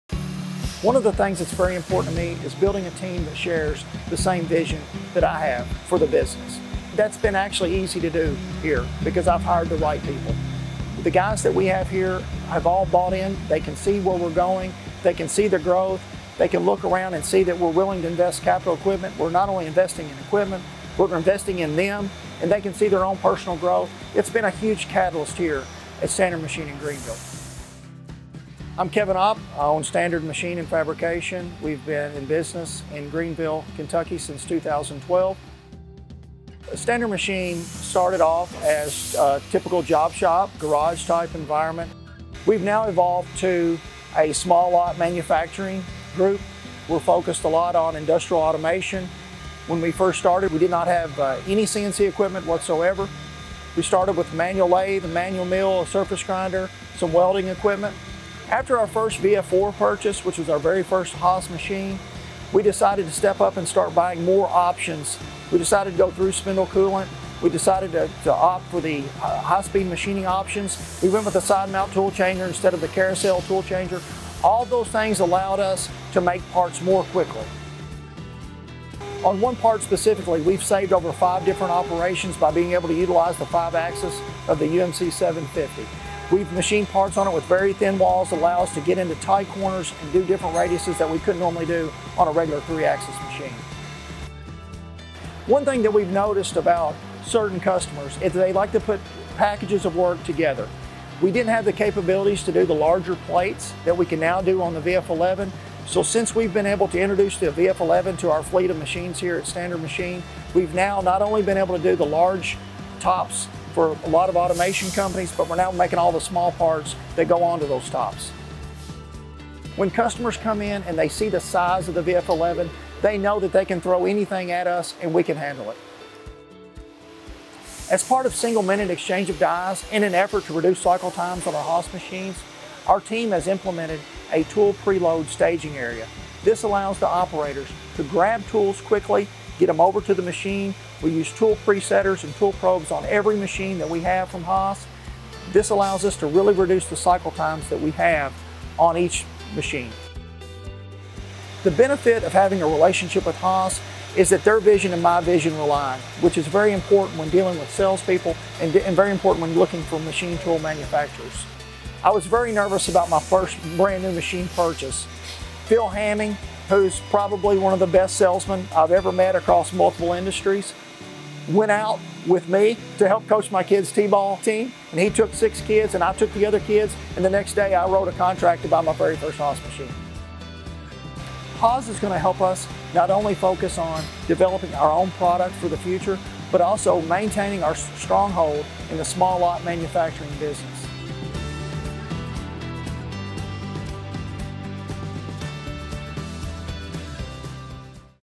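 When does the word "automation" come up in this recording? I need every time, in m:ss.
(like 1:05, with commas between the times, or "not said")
0:48, 1:54.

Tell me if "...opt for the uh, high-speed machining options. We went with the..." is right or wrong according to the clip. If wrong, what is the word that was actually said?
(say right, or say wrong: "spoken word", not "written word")
right.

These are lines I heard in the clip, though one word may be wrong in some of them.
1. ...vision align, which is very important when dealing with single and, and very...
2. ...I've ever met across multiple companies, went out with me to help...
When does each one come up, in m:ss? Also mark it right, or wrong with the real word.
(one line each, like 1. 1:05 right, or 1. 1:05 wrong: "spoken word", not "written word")
1. 2:35 wrong: "salespeople", not "single"
2. 2:48 wrong: "industries", not "companies".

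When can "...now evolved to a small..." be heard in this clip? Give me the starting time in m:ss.
0:42.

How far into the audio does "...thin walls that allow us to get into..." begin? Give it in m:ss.
1:27.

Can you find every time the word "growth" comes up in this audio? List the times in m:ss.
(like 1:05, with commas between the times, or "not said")
0:15, 0:23.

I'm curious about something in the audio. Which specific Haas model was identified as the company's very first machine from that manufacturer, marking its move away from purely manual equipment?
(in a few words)
VF4.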